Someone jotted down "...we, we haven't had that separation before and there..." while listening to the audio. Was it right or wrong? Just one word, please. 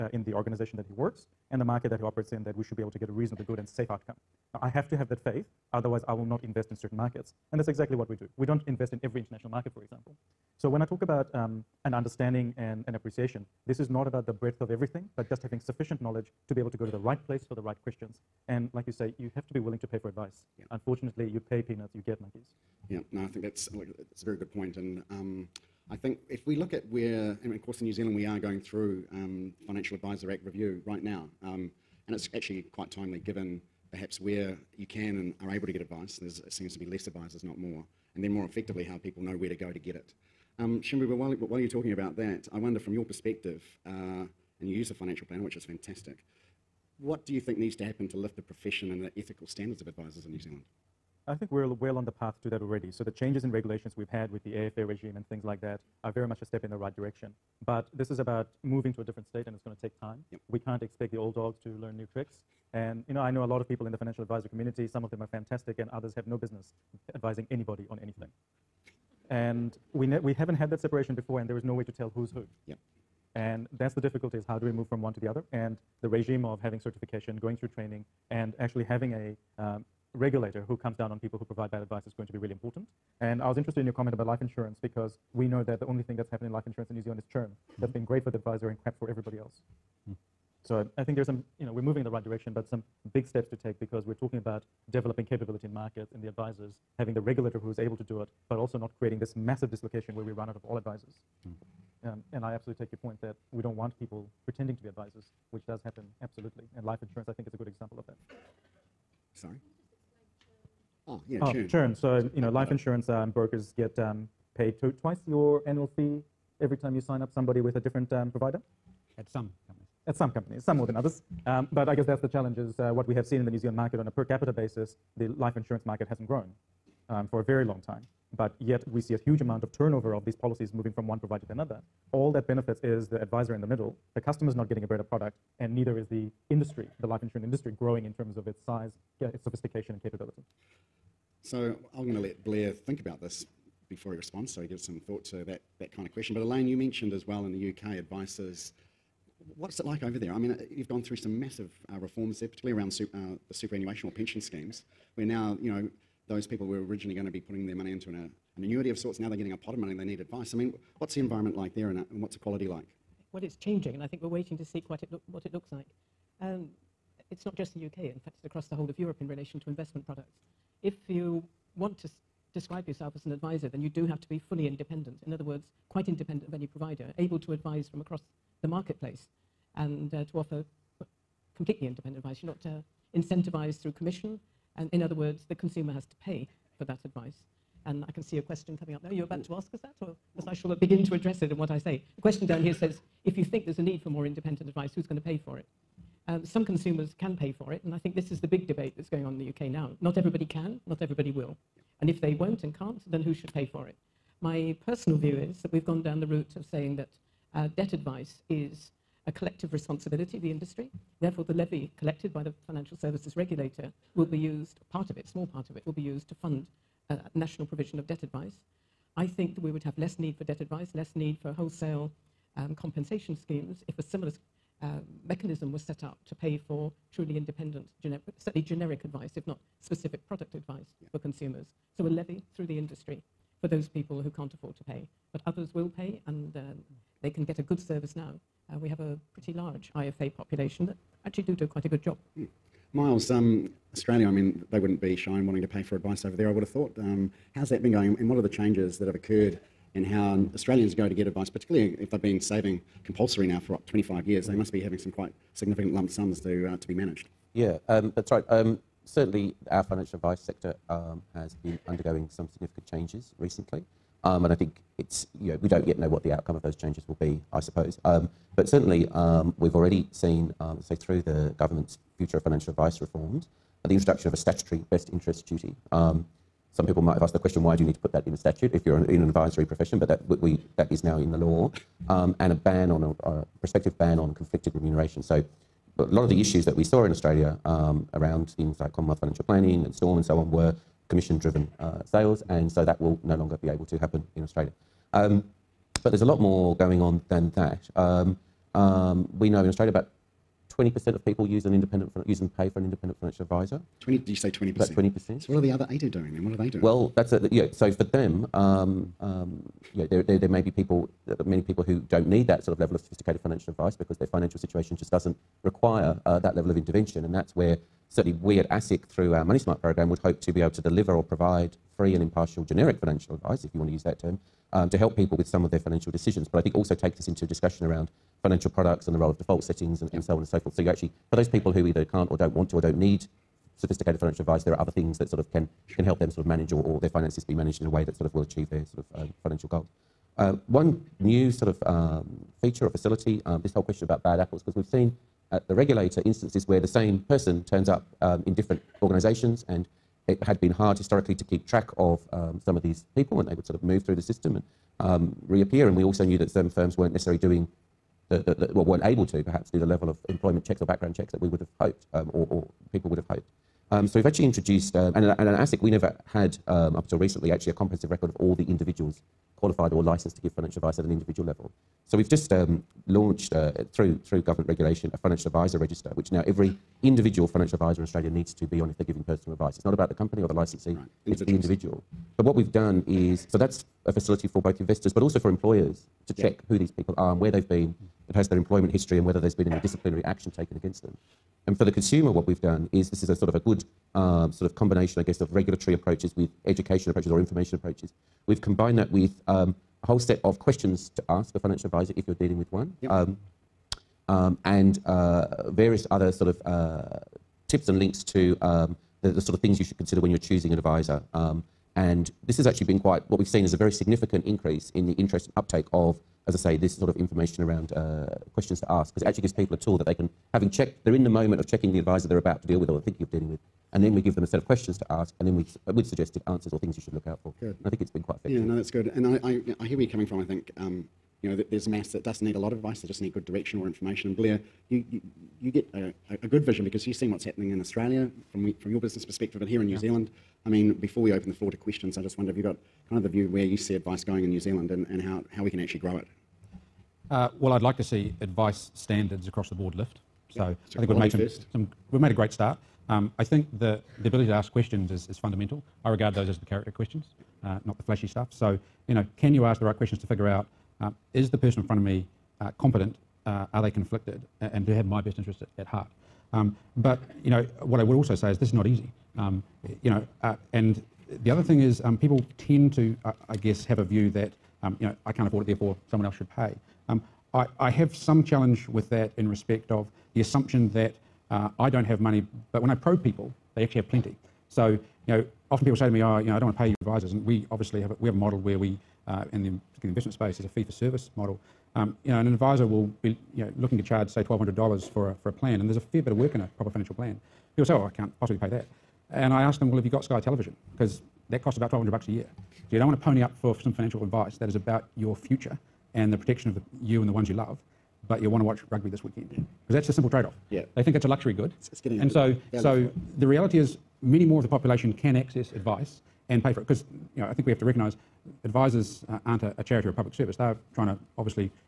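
right.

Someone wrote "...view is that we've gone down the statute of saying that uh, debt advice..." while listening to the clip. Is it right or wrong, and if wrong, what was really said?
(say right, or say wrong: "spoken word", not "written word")
wrong: "route", not "statute".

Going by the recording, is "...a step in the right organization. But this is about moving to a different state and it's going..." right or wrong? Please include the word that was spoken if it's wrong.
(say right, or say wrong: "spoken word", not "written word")
wrong: "direction", not "organization".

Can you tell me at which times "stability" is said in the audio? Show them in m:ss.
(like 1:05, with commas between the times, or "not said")
not said.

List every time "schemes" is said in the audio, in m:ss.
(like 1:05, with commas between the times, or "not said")
2:34, 3:43.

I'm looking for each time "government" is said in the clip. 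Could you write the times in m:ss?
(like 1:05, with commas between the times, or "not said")
4:31, 6:14.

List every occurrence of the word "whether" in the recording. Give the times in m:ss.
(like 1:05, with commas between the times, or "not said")
6:29.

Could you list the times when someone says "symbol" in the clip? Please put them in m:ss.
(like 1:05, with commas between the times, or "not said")
not said.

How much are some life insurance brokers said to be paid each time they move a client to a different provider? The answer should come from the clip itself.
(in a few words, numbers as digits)
Twice your annual fee.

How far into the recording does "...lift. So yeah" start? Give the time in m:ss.
7:29.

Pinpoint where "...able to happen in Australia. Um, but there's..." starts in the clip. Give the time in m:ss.
4:53.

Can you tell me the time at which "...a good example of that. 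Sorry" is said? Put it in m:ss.
1:47.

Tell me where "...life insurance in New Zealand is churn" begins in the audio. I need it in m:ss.
1:26.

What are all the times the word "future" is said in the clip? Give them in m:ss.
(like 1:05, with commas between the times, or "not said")
4:32, 8:25.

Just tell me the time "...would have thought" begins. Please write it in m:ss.
4:06.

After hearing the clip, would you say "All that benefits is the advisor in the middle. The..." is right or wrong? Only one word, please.
right.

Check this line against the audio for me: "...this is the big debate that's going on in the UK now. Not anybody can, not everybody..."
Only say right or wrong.
wrong.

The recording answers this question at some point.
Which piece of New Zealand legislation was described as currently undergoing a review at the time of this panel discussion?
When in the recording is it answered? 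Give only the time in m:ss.
0:29.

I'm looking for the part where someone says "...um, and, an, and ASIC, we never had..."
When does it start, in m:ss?
6:04.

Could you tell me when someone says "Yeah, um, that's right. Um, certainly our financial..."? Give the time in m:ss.
4:17.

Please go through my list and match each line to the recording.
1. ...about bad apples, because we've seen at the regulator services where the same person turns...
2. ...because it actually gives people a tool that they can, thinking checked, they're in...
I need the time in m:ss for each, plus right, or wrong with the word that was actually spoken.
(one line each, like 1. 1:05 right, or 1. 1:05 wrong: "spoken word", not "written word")
1. 5:44 wrong: "instances", not "services"
2. 6:59 wrong: "having", not "thinking".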